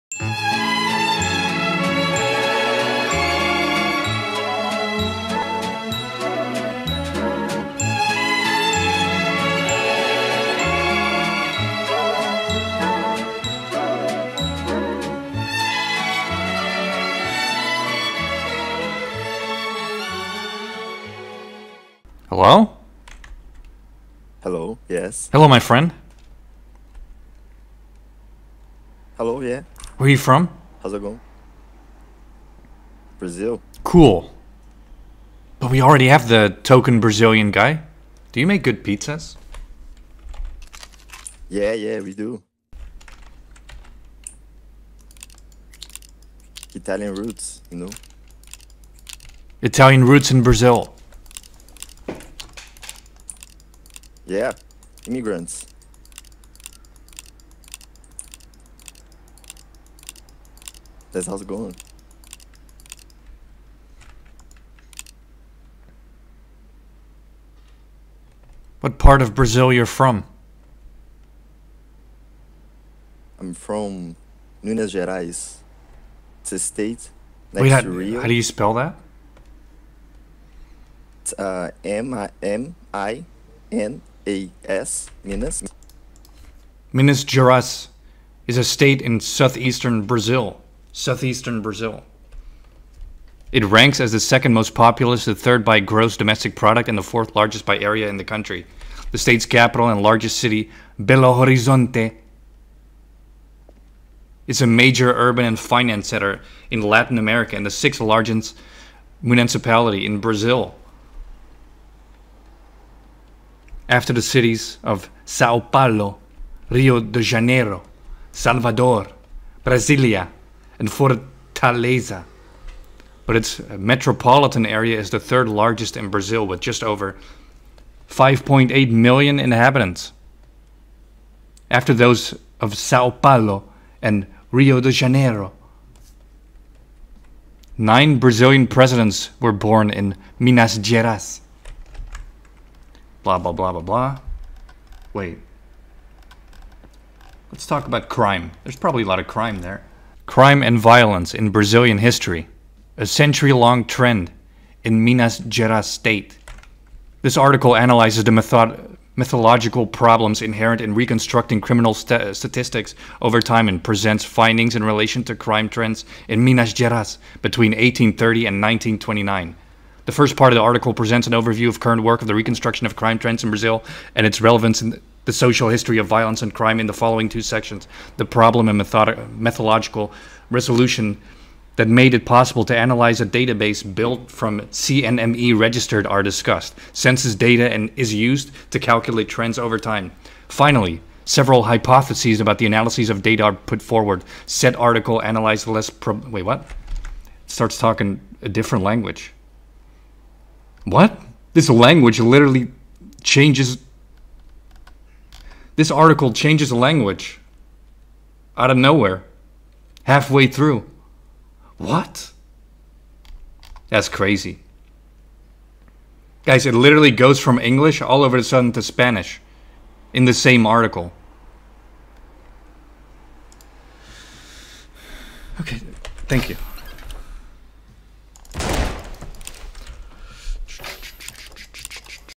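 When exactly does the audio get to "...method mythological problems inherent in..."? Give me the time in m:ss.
2:38.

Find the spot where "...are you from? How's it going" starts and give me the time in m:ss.
0:30.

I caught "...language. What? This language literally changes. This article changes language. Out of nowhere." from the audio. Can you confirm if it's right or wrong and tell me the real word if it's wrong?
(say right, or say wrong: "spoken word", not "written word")
right.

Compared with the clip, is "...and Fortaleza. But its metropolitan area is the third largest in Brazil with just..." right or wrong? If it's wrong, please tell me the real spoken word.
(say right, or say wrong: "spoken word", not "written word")
right.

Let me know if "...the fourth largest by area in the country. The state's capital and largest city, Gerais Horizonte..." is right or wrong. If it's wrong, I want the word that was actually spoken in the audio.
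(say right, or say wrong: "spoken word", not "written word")
wrong: "Belo", not "Gerais".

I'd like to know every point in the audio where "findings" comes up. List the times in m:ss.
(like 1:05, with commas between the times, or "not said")
2:44.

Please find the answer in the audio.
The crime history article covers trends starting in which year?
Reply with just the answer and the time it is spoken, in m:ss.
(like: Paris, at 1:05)
1830, at 2:47.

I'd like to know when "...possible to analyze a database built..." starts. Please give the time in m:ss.
3:02.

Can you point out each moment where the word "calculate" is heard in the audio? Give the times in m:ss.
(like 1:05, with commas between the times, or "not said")
3:08.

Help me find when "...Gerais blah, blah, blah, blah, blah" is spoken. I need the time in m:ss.
2:20.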